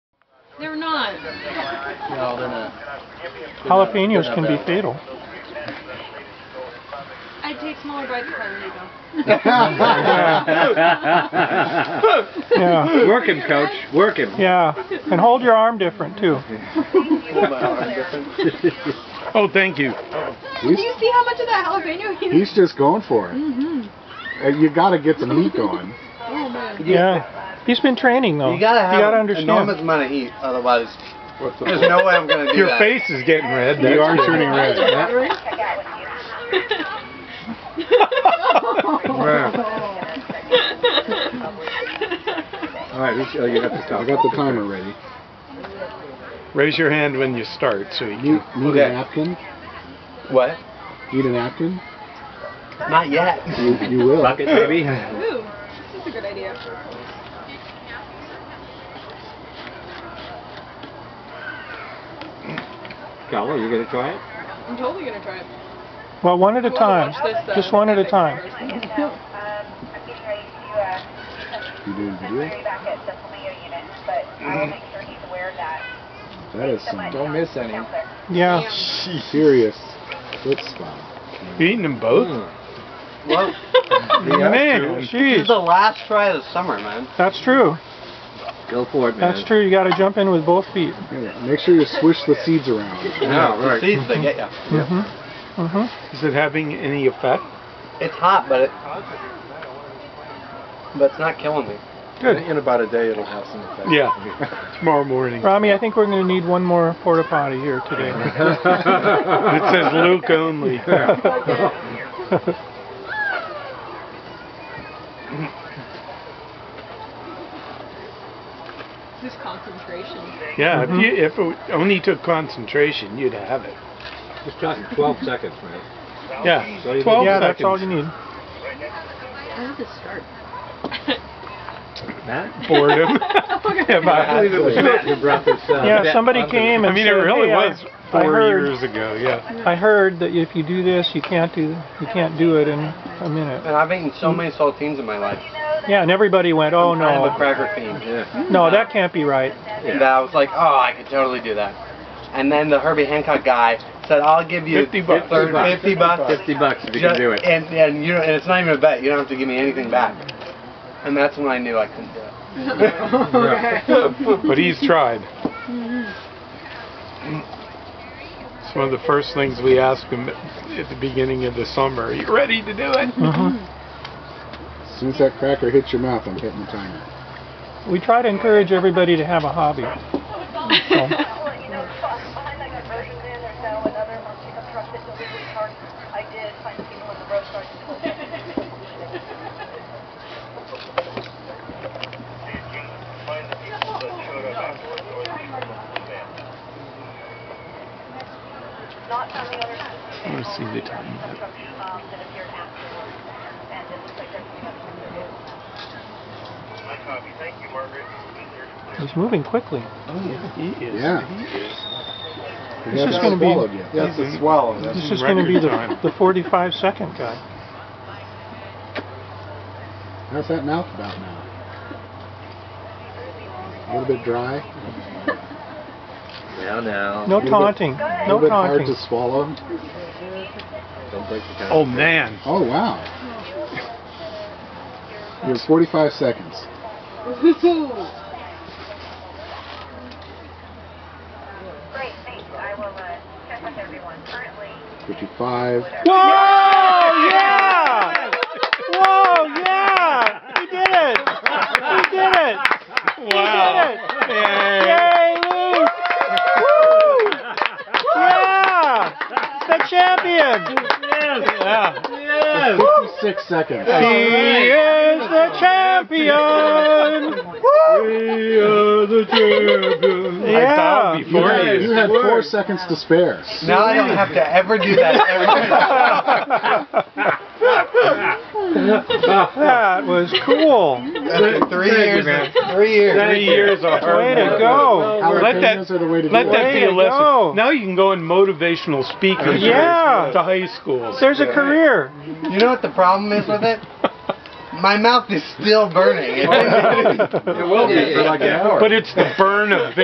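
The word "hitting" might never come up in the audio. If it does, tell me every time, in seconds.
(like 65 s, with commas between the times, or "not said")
176 s.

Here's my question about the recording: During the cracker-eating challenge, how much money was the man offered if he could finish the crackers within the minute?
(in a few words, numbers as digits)
$50.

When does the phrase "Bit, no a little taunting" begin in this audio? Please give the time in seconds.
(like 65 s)
227 s.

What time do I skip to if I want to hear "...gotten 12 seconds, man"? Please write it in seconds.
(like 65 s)
124 s.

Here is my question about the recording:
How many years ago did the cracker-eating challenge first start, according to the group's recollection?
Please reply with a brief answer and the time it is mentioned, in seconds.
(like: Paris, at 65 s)
4 years, at 138 s.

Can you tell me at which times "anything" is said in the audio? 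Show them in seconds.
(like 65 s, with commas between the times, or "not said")
159 s.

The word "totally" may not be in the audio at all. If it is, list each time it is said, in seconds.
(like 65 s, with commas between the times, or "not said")
64 s, 151 s.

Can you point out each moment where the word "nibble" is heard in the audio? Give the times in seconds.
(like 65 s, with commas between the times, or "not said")
not said.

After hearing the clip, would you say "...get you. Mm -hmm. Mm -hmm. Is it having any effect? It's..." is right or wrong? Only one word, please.
right.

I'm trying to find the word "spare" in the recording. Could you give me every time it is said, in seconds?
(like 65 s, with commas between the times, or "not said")
272 s.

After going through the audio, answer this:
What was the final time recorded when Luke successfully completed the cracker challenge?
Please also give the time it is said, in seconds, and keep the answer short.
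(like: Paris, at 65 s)
56 seconds, at 263 s.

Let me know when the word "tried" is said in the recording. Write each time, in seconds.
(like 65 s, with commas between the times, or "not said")
164 s.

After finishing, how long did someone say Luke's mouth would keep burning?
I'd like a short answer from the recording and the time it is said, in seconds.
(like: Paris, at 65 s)
An hour, at 298 s.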